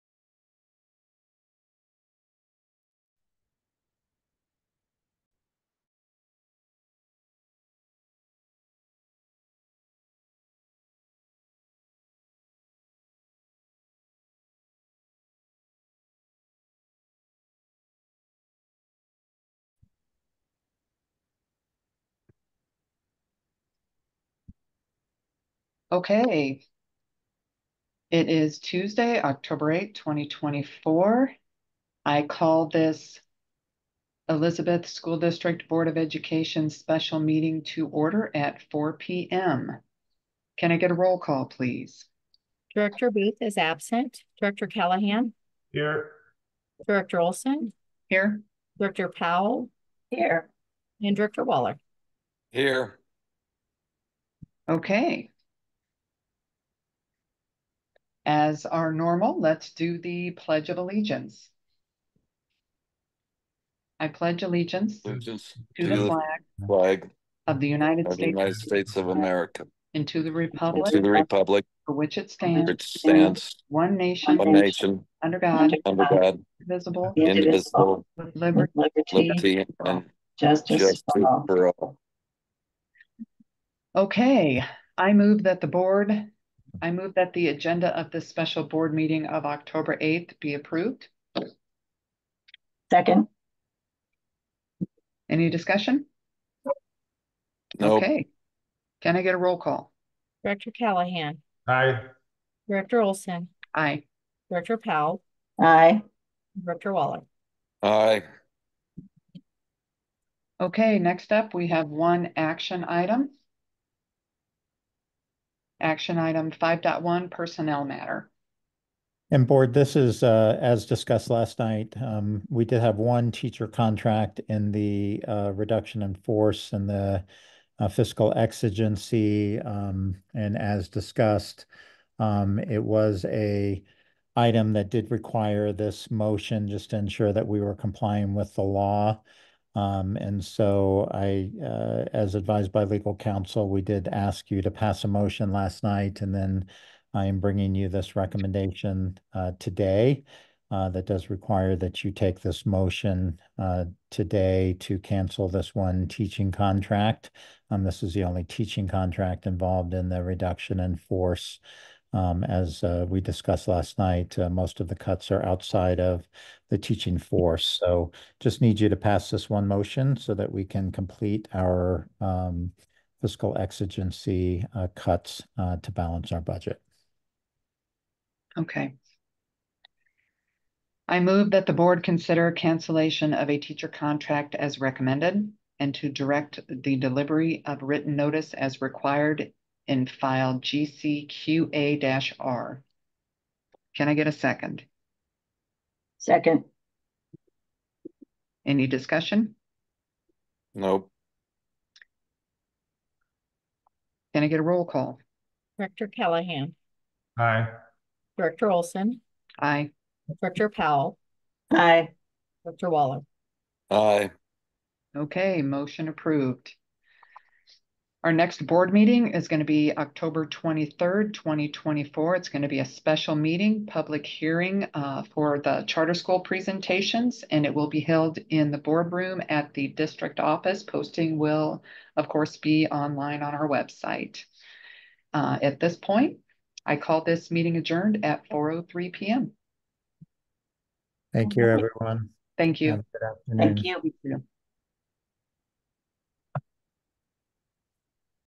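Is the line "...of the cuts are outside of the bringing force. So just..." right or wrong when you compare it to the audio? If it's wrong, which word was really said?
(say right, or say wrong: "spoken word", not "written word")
wrong: "teaching", not "bringing".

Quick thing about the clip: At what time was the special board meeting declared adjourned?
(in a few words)
4:03 p.m.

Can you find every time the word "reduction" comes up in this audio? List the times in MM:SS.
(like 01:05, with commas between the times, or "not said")
02:05, 02:40.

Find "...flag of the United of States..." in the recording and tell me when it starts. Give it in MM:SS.
01:06.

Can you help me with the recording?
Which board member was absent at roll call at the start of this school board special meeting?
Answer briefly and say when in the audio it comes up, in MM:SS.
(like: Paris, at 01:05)
Director Booth, at 00:42.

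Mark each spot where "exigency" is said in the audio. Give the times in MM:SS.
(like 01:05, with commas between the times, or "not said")
02:08, 02:53.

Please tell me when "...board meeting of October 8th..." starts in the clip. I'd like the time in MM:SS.
01:28.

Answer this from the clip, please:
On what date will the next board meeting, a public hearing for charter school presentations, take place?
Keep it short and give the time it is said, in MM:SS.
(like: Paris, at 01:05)
October 23, 2024, at 03:39.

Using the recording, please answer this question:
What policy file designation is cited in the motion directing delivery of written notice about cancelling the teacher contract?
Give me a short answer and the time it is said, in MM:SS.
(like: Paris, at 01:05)
GCQA-R, at 03:10.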